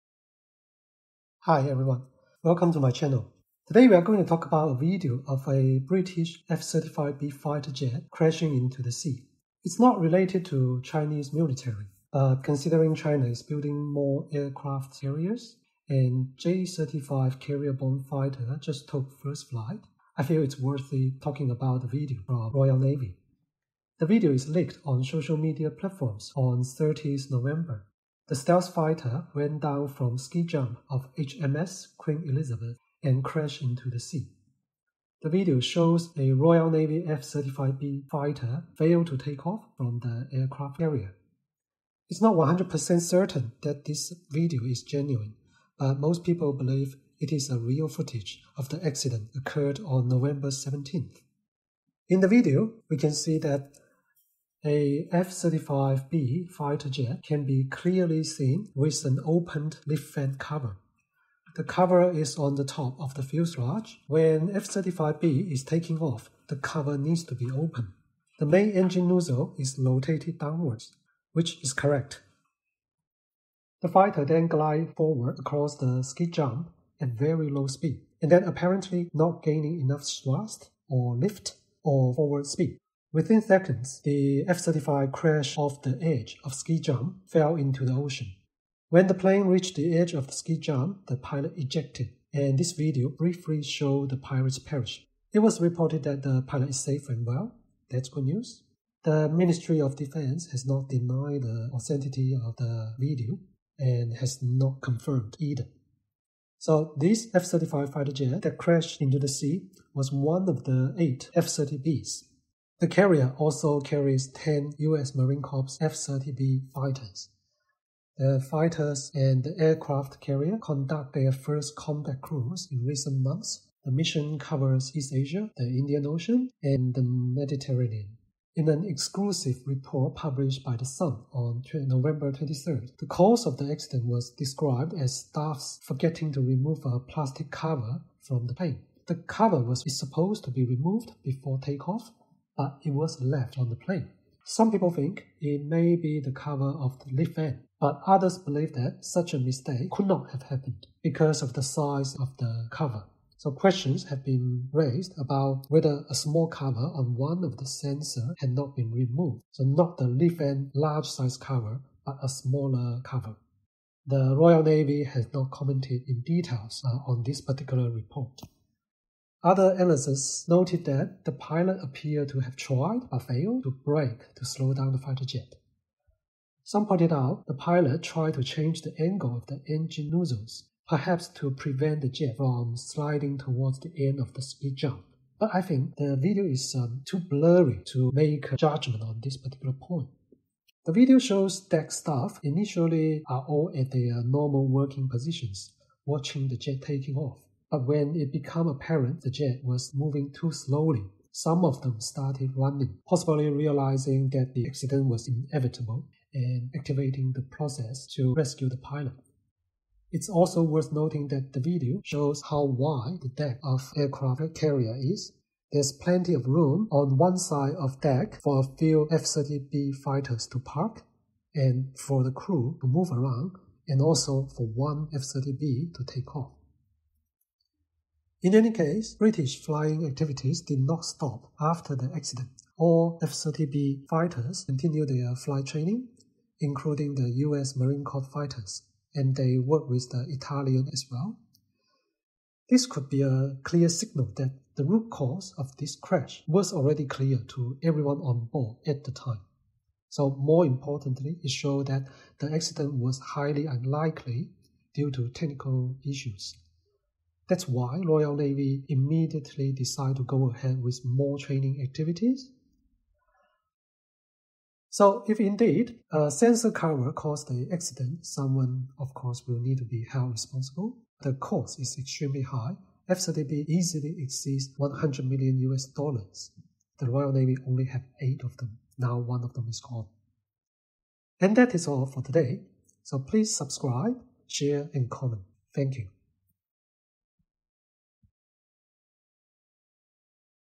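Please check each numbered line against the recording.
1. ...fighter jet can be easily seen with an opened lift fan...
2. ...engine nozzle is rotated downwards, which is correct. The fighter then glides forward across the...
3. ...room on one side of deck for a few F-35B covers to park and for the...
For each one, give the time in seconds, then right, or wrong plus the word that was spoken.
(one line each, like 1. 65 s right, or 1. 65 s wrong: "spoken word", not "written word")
1. 56 s wrong: "clearly", not "easily"
2. 68 s right
3. 216 s wrong: "fighters", not "covers".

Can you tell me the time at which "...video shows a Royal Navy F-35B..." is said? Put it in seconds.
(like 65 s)
35 s.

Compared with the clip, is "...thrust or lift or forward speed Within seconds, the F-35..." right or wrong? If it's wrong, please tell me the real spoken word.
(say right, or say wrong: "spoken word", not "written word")
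right.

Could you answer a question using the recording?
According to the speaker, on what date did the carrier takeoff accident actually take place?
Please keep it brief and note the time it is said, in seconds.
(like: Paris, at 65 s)
November 17th, at 50 s.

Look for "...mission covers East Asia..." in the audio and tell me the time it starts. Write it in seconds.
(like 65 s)
123 s.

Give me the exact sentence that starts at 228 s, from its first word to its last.
In any case, British flying activities did not stop after the accident.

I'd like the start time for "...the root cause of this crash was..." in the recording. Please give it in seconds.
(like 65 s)
244 s.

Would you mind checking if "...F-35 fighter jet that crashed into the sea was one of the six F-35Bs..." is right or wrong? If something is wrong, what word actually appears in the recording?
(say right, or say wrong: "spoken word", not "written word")
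wrong: "eight", not "six".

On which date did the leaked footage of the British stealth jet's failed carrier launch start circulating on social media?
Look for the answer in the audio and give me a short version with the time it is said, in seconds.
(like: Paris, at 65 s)
30th November, at 26 s.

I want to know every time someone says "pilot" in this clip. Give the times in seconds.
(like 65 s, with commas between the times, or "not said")
91 s, 96 s, 171 s, 177 s, 208 s.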